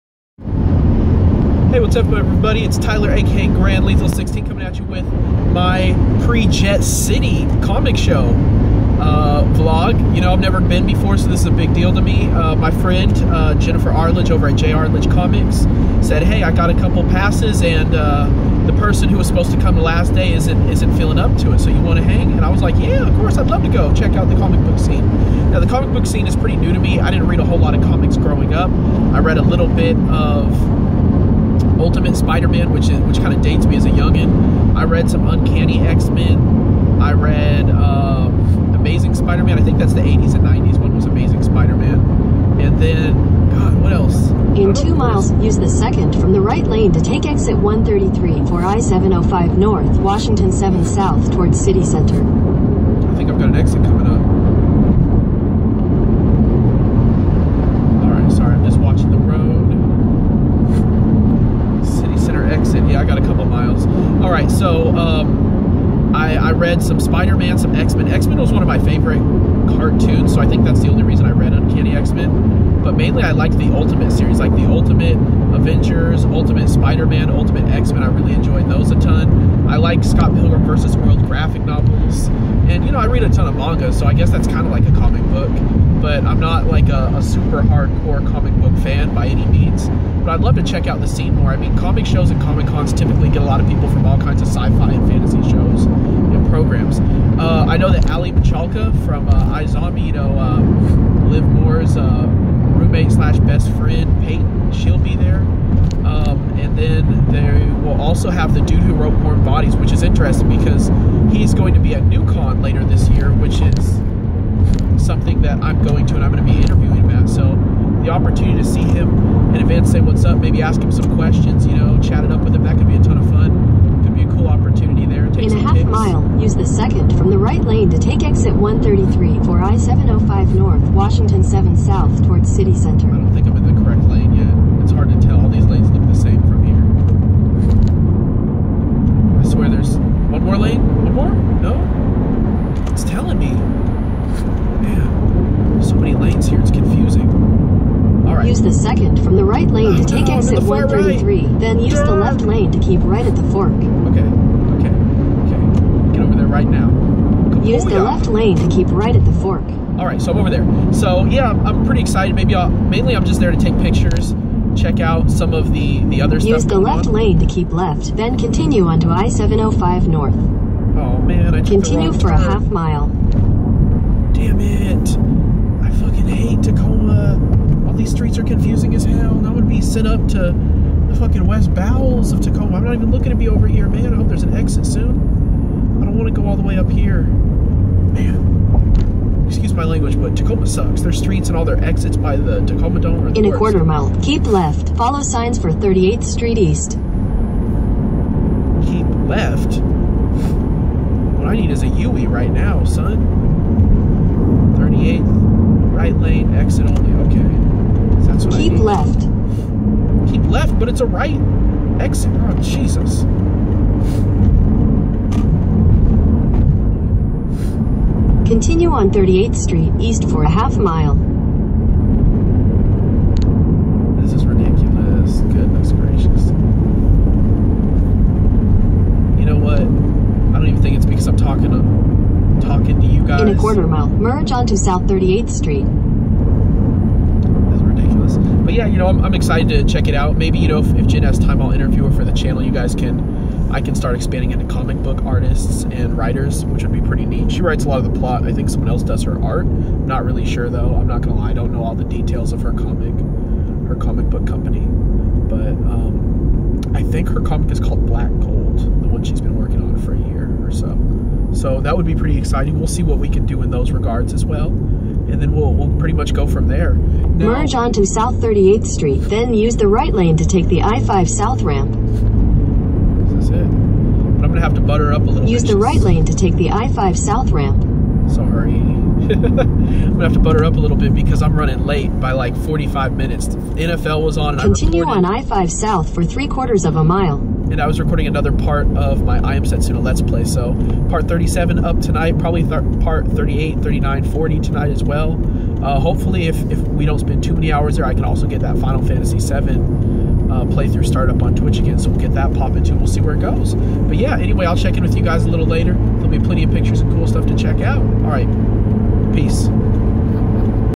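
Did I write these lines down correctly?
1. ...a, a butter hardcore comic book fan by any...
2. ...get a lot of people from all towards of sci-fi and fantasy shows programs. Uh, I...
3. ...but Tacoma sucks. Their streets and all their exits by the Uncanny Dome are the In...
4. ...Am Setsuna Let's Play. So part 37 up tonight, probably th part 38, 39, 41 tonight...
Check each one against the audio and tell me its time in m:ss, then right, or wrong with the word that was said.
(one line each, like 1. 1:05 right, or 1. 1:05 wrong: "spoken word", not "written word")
1. 1:26 wrong: "super", not "butter"
2. 1:33 wrong: "kinds", not "towards"
3. 3:10 wrong: "Tacoma", not "Uncanny"
4. 4:49 wrong: "40", not "41".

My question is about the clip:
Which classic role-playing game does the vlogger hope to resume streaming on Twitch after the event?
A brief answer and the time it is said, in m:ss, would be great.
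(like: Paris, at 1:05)
Final Fantasy 7, at 4:58.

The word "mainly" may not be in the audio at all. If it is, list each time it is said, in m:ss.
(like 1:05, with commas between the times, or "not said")
1:12, 2:42.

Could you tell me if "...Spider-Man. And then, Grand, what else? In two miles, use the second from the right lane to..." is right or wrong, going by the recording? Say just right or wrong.
wrong.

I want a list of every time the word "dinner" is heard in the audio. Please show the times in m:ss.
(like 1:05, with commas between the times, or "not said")
not said.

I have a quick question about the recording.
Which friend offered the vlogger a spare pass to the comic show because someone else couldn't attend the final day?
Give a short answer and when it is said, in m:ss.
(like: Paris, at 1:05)
Jennifer Arledge, at 0:13.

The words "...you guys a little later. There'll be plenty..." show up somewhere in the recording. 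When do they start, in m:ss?
5:05.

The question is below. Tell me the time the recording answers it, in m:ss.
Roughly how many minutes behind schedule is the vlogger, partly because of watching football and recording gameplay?
4:42.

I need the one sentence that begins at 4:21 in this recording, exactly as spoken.
So that would be pretty exciting.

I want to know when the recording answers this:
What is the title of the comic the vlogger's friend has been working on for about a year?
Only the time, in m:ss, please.
4:18.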